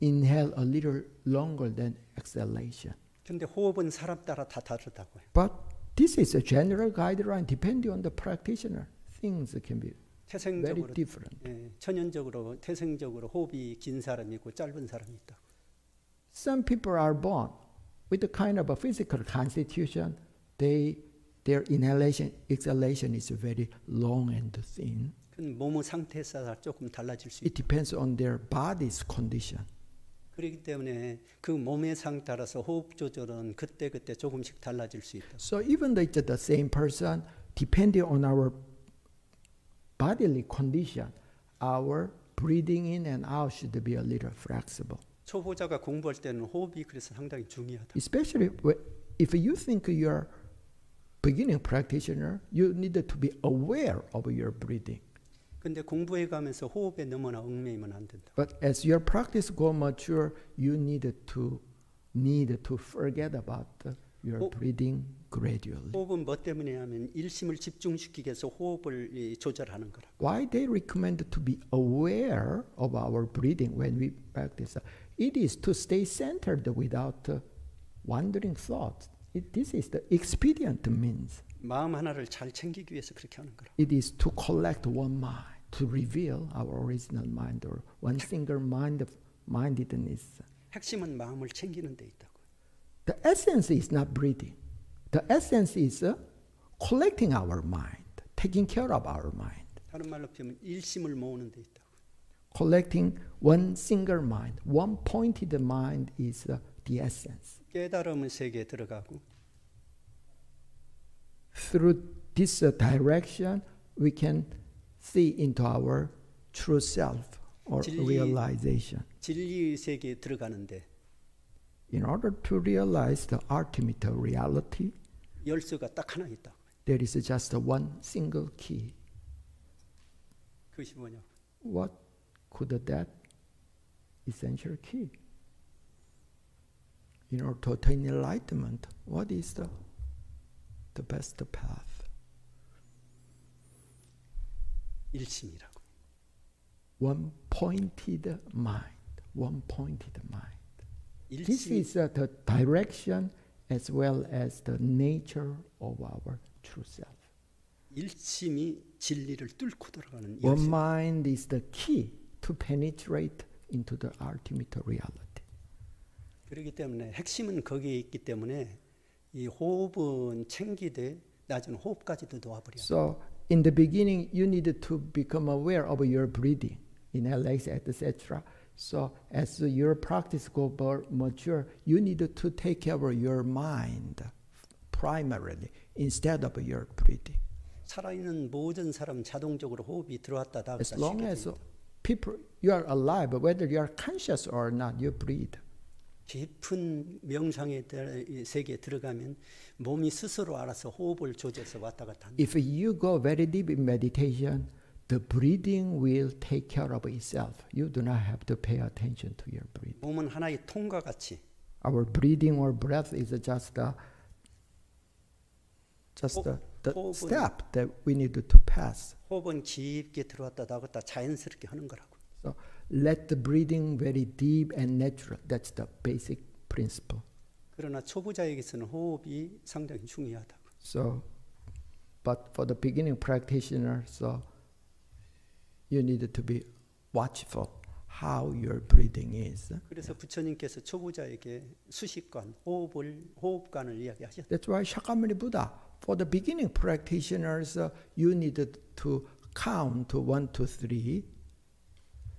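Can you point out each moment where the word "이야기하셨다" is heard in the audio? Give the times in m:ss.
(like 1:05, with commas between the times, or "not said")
4:03.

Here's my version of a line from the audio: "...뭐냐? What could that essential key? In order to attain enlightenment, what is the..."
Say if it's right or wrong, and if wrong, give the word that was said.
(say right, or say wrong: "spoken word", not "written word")
right.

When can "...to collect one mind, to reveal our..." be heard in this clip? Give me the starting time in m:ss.
1:24.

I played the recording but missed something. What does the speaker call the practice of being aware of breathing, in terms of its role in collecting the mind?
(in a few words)
Expedient means.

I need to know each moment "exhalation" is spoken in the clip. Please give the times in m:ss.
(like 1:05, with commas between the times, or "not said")
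0:02, 0:22.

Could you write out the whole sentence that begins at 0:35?
So even the, the same person, depending on our bodily condition, our breathing in and out should be a little flexible.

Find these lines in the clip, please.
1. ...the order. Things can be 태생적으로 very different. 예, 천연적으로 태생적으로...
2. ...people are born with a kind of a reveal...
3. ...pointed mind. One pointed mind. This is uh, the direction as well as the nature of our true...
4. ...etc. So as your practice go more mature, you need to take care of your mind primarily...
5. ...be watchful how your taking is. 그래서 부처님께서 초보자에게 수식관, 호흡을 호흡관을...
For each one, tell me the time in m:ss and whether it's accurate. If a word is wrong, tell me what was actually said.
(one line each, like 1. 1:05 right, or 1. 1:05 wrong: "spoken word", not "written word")
1. 0:08 wrong: "practitioner", not "order"
2. 0:16 wrong: "physical", not "reveal"
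3. 2:27 right
4. 2:57 right
5. 3:56 wrong: "breathing", not "taking".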